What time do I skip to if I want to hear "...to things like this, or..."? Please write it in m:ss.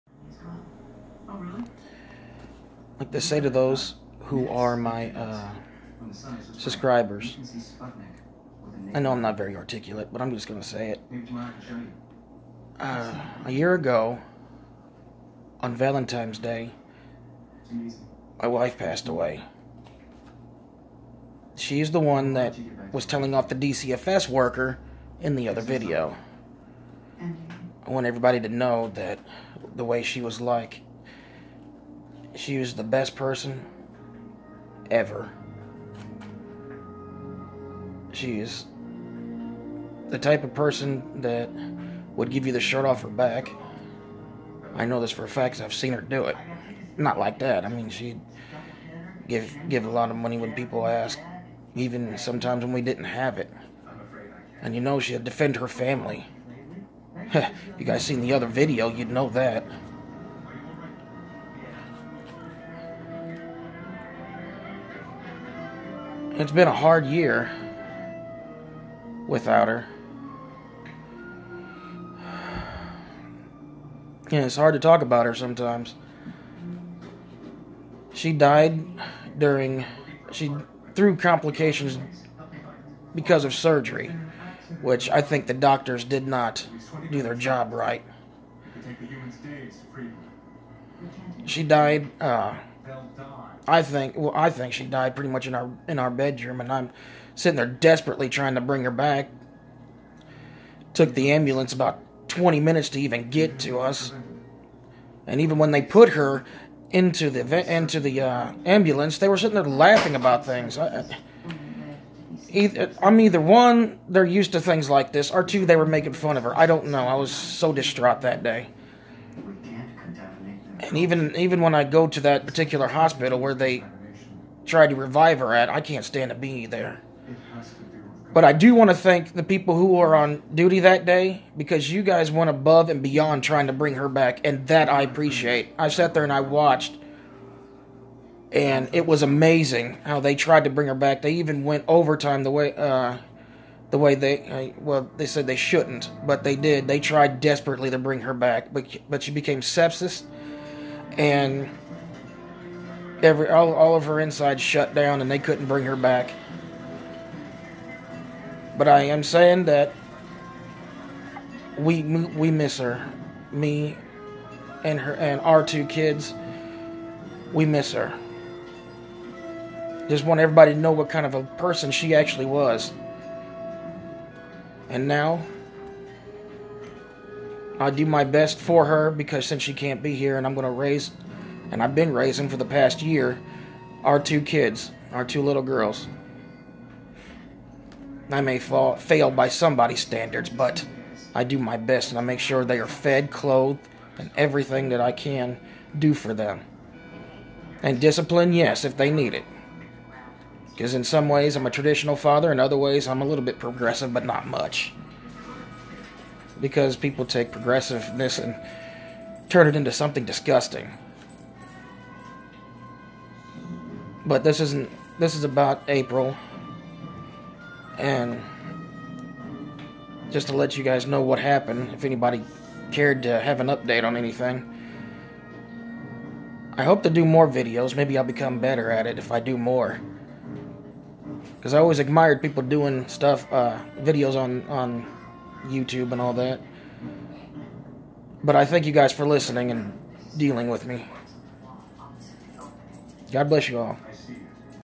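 1:54.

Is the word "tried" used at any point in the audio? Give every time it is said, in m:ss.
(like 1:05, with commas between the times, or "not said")
2:04, 2:20, 2:27.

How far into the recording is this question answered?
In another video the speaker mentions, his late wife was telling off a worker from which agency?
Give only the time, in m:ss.
0:23.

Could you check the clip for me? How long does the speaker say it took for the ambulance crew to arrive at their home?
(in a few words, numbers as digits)
20 minutes.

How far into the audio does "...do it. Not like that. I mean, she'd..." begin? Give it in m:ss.
0:46.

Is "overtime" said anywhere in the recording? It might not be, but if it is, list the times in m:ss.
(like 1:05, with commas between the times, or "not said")
2:21.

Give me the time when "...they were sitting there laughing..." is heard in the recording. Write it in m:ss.
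1:49.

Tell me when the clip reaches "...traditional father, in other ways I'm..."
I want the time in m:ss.
3:21.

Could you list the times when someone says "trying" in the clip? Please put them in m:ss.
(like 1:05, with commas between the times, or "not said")
1:38, 2:13.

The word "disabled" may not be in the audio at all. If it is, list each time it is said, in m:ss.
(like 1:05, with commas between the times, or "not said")
not said.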